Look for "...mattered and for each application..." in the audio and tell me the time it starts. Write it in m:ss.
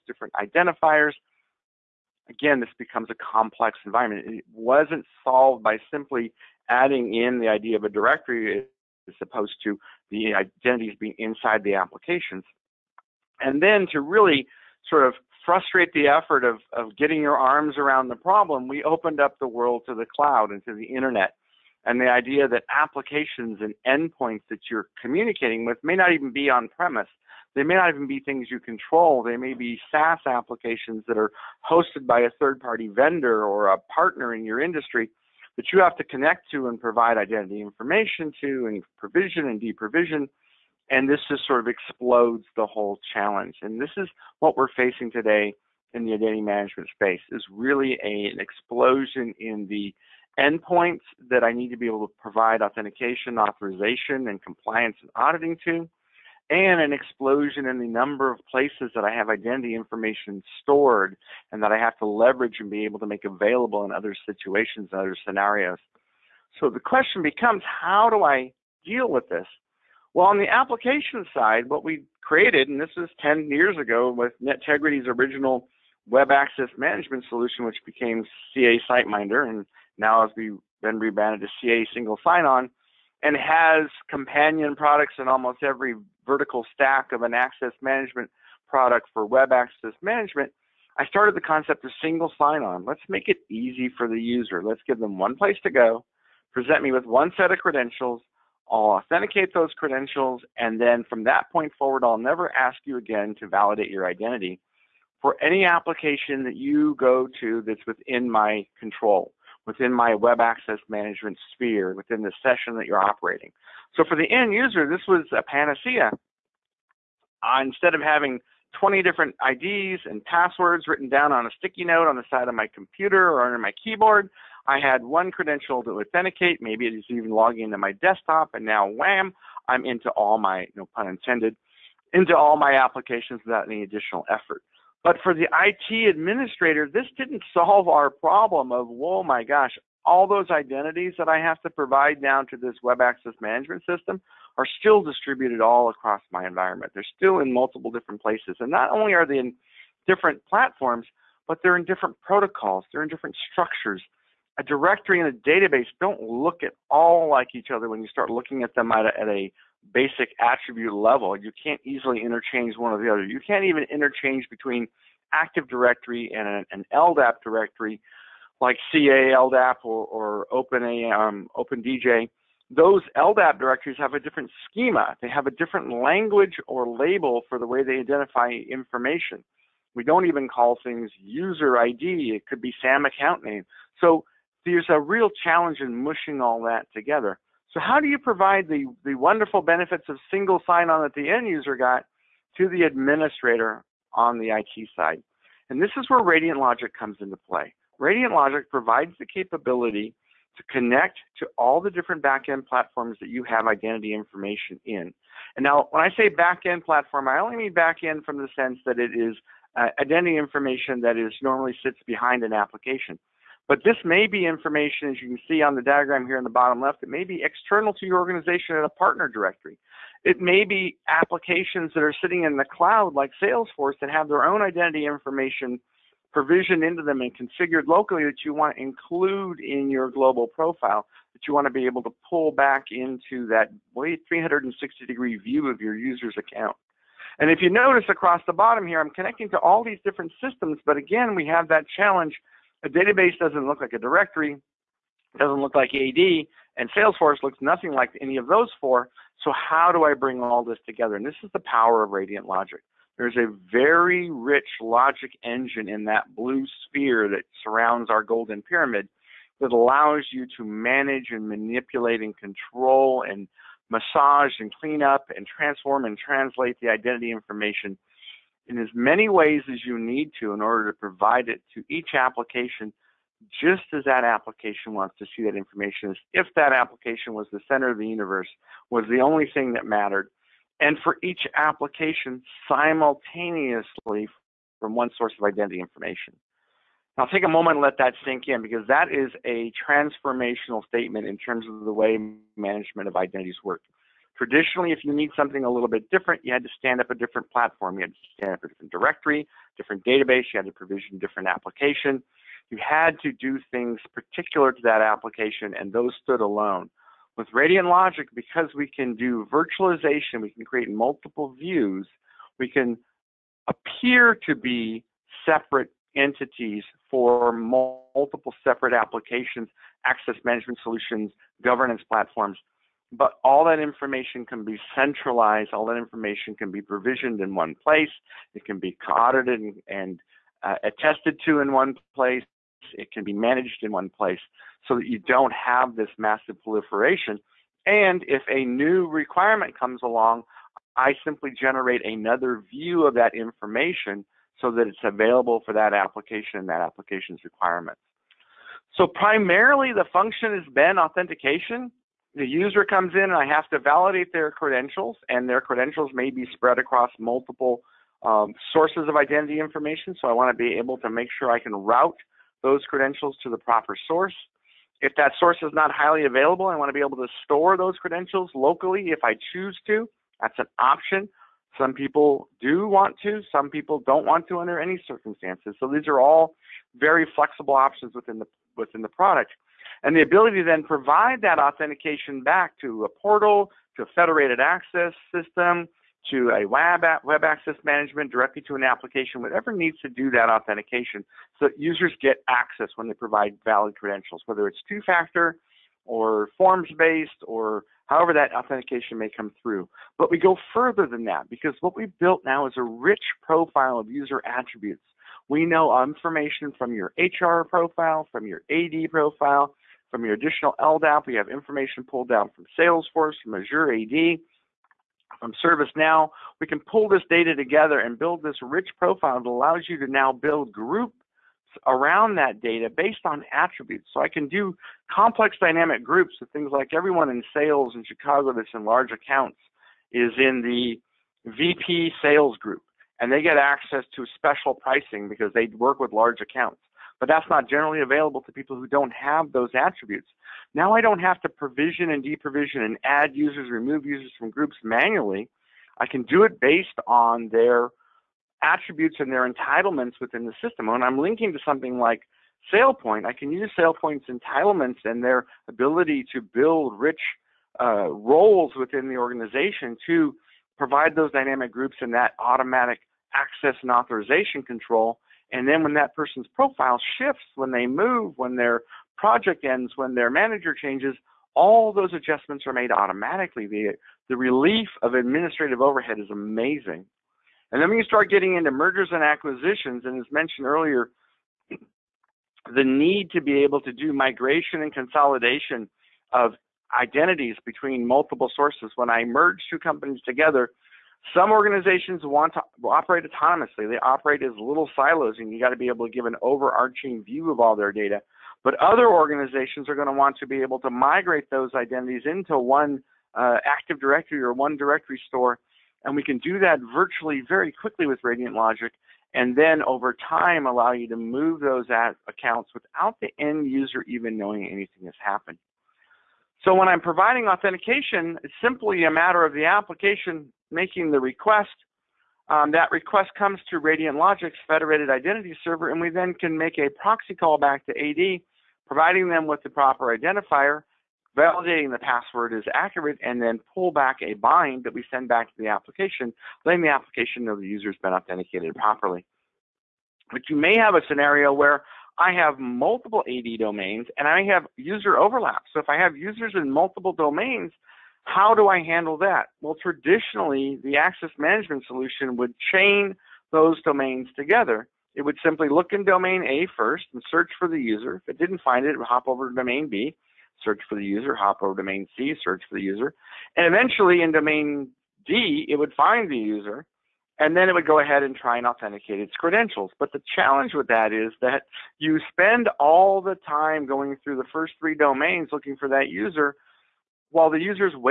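4:39.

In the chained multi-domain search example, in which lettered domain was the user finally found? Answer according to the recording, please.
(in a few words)
Domain D.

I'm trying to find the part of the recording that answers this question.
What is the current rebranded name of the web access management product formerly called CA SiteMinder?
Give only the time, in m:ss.
1:21.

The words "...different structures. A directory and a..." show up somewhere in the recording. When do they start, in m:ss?
2:33.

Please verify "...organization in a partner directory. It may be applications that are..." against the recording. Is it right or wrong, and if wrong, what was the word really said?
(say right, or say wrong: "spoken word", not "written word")
right.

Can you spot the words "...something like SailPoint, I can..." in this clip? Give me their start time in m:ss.
7:31.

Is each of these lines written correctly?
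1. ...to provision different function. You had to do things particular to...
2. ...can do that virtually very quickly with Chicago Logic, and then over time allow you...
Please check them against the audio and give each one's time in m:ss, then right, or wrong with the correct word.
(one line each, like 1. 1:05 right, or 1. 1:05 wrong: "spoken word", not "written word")
1. 5:00 wrong: "application", not "function"
2. 8:26 wrong: "Radiant", not "Chicago".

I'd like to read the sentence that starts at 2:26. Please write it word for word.
They're still in multiple different places.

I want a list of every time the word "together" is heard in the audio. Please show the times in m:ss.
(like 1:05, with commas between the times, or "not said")
3:06, 4:10, 6:57, 8:10, 9:14.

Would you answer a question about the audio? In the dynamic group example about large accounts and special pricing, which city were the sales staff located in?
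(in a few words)
Chicago.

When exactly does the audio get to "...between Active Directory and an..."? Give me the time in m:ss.
2:44.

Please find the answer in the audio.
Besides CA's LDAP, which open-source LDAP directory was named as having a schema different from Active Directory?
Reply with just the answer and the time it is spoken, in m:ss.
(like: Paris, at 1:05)
OpenDJ, at 2:51.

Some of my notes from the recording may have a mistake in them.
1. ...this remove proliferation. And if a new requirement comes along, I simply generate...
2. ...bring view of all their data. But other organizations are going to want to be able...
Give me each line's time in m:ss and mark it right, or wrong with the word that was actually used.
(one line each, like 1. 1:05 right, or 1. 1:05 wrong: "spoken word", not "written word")
1. 5:35 wrong: "massive", not "remove"
2. 8:16 wrong: "overarching", not "bring".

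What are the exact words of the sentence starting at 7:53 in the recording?
The, the relief of administrative overhead is amazing.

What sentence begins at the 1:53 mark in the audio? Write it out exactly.
So for the end user, this was a panacea.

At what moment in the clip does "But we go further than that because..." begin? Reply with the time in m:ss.
6:40.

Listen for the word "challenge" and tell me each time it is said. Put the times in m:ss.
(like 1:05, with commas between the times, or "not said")
0:43, 3:05, 4:01, 9:30.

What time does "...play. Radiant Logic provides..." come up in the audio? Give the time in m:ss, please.
3:17.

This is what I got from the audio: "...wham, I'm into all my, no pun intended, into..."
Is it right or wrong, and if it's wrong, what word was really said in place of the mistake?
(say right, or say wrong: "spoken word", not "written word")
right.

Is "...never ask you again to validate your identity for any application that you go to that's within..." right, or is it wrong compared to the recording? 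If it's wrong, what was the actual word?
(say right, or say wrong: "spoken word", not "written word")
right.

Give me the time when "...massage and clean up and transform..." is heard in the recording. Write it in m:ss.
4:23.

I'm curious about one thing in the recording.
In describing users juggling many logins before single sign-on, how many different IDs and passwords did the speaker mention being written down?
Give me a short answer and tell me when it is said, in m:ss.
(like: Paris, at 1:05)
20, at 1:58.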